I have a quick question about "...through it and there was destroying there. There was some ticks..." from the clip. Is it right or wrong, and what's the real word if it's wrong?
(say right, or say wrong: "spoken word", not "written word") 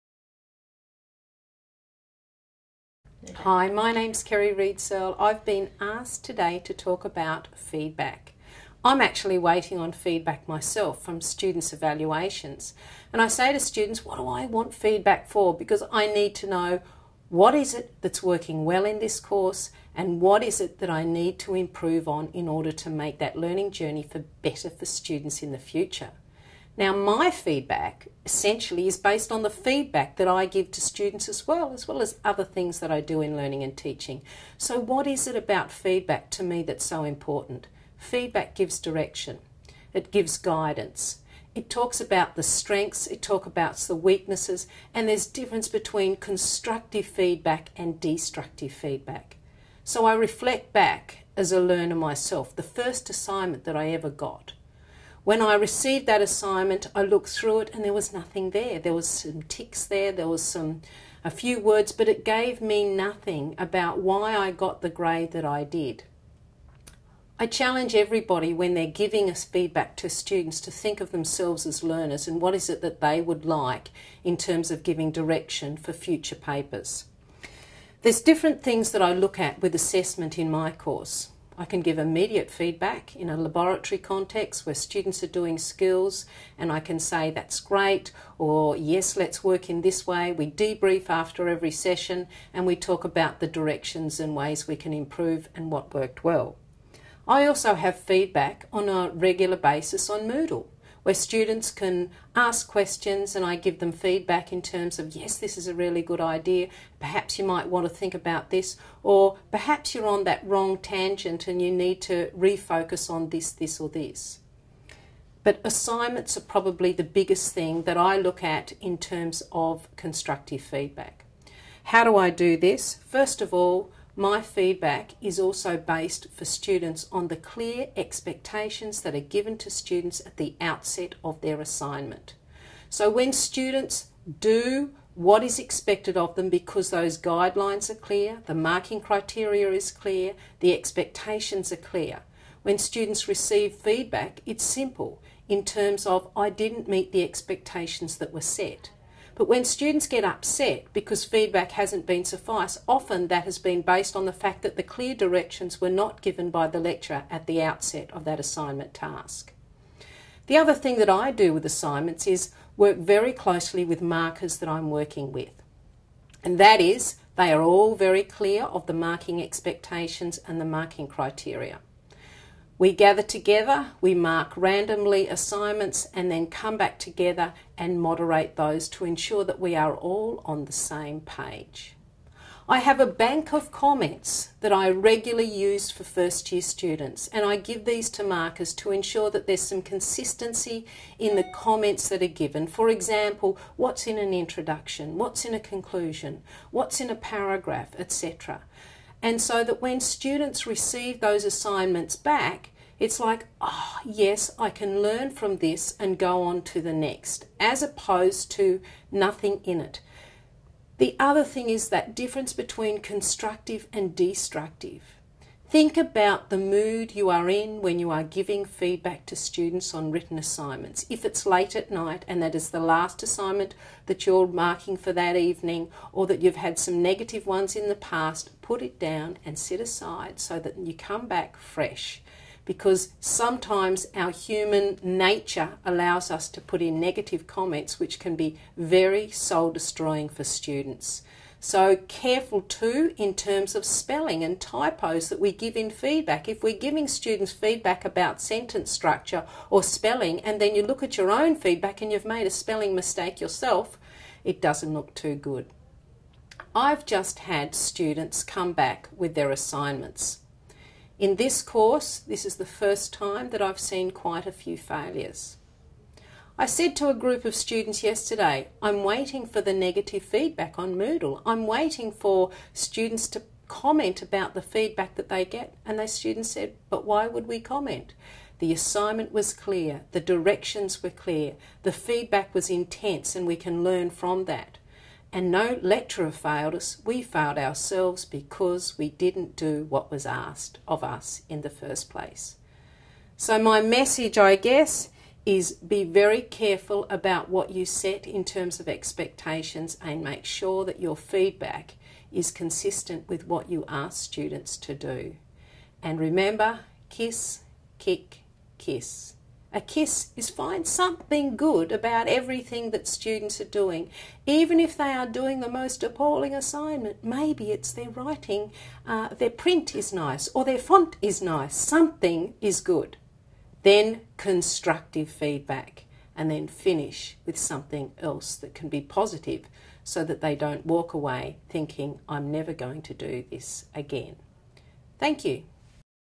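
wrong: "nothing", not "destroying".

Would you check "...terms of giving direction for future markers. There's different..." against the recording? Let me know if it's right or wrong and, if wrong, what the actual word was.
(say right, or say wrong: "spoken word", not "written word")
wrong: "papers", not "markers".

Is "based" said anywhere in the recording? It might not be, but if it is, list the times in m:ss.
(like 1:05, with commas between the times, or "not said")
0:28, 2:05, 2:33.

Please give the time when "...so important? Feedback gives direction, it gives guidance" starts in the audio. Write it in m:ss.
0:36.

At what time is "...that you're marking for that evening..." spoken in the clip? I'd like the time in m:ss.
3:44.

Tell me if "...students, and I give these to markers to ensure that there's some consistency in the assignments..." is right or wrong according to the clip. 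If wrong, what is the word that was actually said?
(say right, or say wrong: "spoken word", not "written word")
wrong: "comments", not "assignments".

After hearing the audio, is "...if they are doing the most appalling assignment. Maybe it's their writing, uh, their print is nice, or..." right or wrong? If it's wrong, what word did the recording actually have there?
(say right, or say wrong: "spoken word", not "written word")
right.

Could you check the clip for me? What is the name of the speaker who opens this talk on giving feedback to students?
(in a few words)
Kerry Reid-Searl.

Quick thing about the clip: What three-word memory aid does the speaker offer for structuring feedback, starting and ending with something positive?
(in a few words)
Kiss, kick, kiss.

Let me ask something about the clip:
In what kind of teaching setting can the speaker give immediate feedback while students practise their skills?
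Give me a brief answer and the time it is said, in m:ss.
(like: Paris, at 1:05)
Laboratory, at 1:23.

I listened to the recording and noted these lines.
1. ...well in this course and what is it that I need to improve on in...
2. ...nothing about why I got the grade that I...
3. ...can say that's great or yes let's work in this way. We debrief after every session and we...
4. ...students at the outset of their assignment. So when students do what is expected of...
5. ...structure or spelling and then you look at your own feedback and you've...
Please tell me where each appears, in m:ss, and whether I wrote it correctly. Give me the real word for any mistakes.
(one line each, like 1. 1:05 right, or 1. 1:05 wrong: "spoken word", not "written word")
1. 0:18 right
2. 1:02 right
3. 1:26 right
4. 2:09 right
5. 4:08 right.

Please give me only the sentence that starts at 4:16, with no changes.
I've just had students come back with their assignments.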